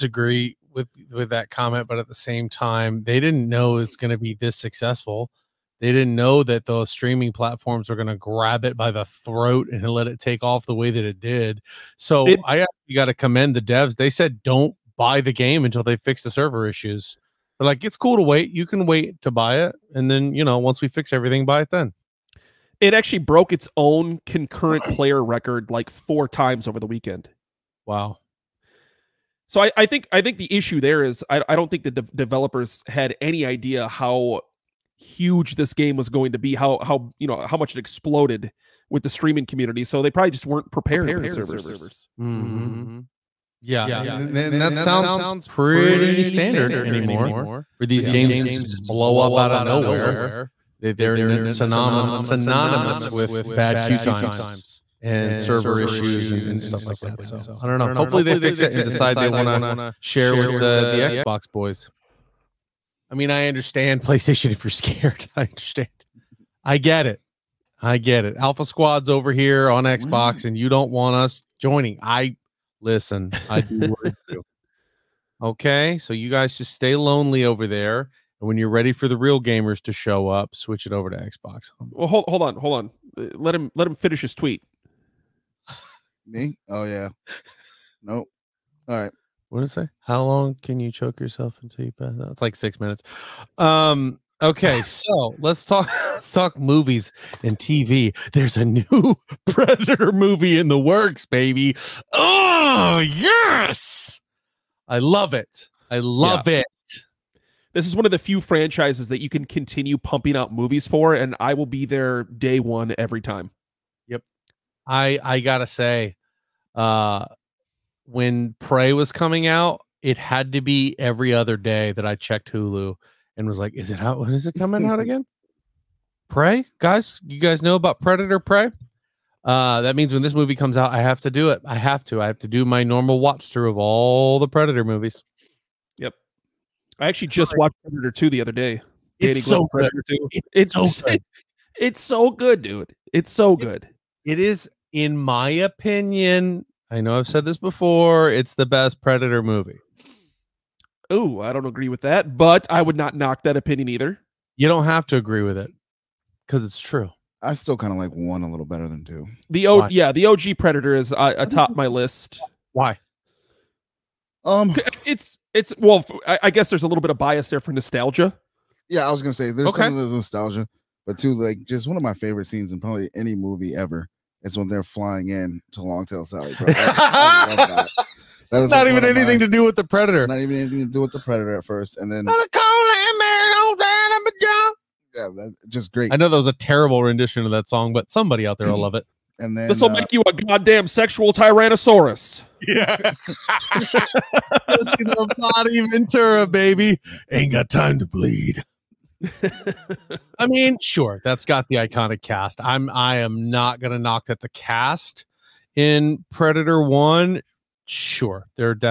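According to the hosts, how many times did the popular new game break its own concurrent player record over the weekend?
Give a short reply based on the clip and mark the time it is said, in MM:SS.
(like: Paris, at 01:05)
4, at 00:25.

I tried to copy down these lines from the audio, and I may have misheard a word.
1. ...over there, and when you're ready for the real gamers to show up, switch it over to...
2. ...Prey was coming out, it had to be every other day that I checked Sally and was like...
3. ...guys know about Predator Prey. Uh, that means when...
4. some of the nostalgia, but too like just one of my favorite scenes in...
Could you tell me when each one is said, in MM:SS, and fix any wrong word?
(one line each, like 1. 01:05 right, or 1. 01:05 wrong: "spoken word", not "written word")
1. 01:17 right
2. 01:58 wrong: "Hulu", not "Sally"
3. 02:07 right
4. 02:49 right.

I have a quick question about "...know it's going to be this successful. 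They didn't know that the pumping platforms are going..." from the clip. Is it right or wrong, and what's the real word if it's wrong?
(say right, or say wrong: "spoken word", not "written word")
wrong: "streaming", not "pumping".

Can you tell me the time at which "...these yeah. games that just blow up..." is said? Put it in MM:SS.
00:47.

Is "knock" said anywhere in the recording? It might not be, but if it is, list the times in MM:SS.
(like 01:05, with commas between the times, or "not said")
02:33, 03:23.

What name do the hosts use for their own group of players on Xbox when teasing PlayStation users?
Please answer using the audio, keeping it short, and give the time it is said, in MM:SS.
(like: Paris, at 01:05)
Alpha Squad, at 01:08.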